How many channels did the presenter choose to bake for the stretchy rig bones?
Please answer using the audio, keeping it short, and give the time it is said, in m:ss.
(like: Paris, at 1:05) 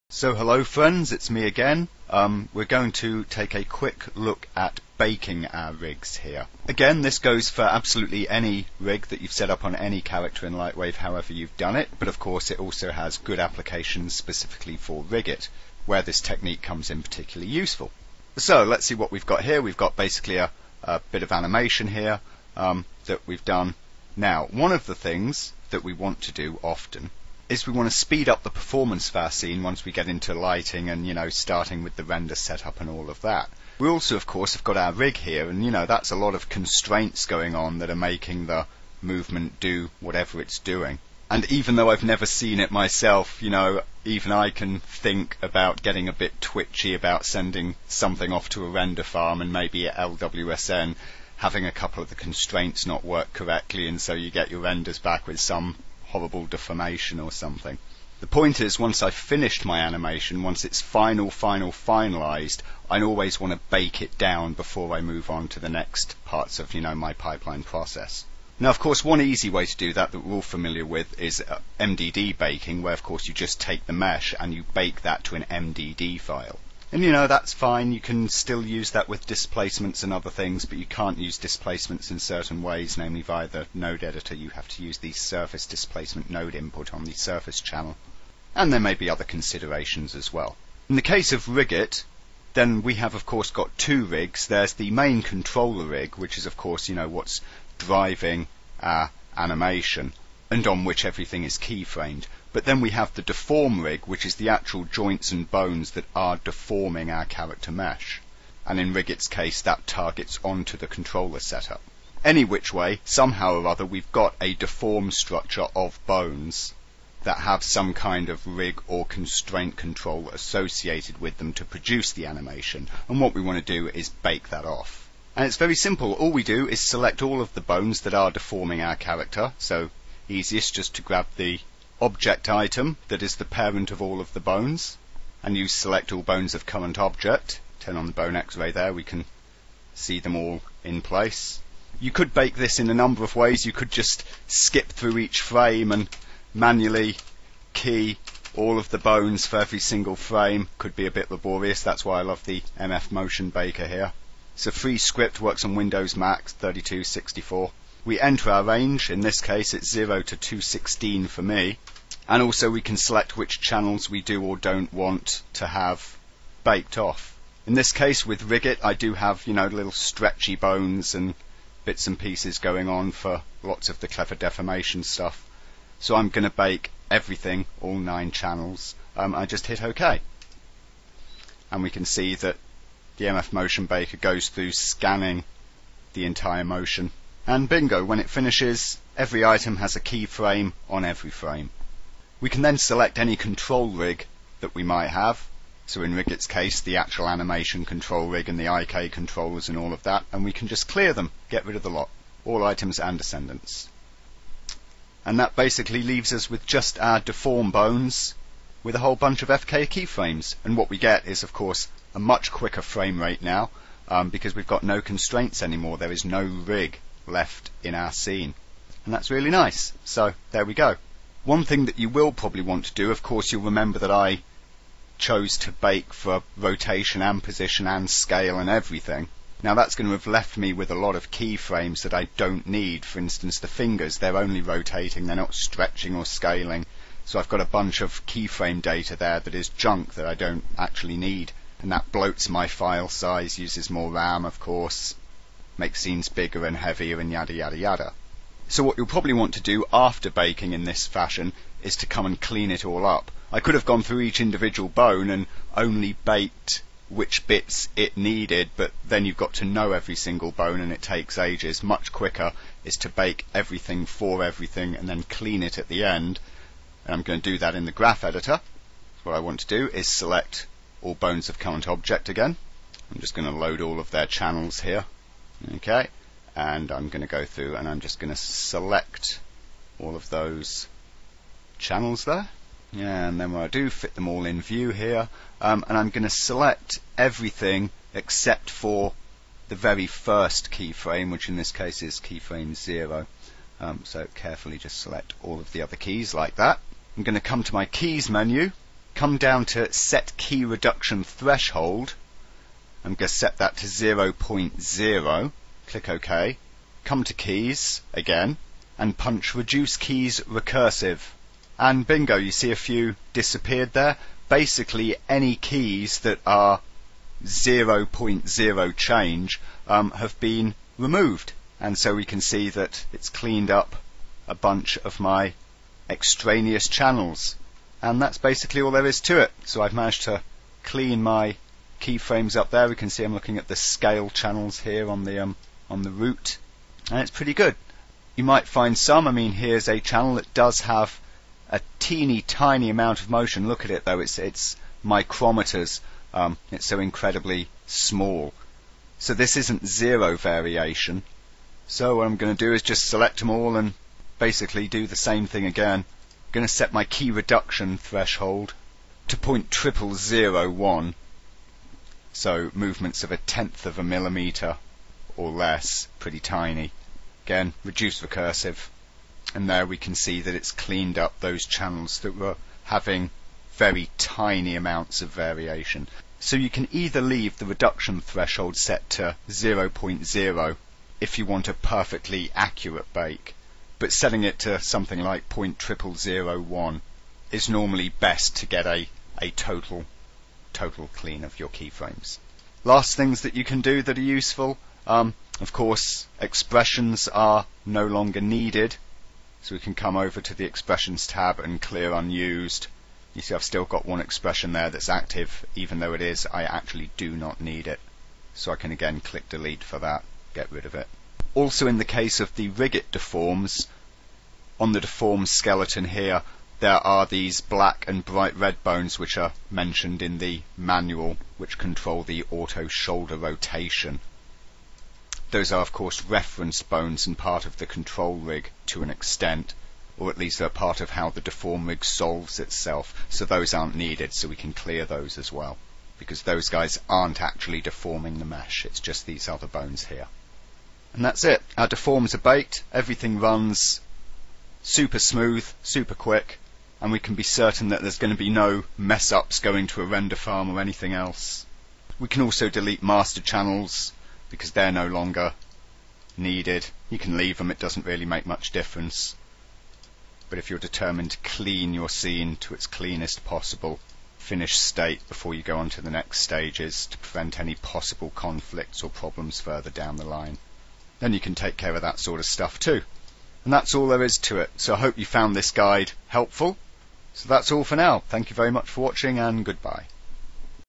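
9, at 2:57.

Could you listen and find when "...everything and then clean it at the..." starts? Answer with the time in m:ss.
4:24.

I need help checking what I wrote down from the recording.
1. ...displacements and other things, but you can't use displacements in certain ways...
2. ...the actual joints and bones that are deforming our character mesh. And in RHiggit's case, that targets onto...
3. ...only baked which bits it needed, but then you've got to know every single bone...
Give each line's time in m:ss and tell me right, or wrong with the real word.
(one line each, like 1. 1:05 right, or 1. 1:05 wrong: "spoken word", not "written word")
1. 1:19 right
2. 1:44 right
3. 4:15 right.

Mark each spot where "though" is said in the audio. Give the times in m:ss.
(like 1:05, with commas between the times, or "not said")
0:41, 5:44, 6:45.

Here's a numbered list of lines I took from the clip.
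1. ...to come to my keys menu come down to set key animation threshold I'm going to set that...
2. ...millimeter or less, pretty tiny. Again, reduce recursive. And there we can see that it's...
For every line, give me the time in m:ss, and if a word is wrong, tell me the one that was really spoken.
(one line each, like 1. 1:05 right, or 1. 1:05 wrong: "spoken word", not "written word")
1. 4:57 wrong: "reduction", not "animation"
2. 6:04 right.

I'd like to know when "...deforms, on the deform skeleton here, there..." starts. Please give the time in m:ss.
6:53.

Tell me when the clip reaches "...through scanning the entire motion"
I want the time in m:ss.
3:04.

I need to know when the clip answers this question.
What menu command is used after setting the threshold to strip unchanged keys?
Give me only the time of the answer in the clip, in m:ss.
5:09.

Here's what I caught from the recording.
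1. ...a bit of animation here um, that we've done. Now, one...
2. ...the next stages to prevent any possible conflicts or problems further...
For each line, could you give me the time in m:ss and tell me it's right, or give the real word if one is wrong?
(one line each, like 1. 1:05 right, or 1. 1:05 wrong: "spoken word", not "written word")
1. 0:20 right
2. 7:46 right.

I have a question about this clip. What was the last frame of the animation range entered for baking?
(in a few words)
216.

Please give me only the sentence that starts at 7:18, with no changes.
It's just these other bones here.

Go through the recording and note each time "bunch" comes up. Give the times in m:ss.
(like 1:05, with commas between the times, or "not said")
3:29, 3:57, 5:24.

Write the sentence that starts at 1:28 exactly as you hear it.
And there may be other considerations as well.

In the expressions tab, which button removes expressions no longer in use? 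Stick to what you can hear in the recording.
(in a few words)
clear unused.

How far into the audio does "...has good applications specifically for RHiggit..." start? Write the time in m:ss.
0:12.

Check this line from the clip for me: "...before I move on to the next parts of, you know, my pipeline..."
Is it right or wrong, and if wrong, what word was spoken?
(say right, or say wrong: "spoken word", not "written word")
right.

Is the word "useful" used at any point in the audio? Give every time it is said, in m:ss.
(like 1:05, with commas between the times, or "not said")
0:17, 6:34.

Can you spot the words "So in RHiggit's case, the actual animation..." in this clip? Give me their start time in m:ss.
3:15.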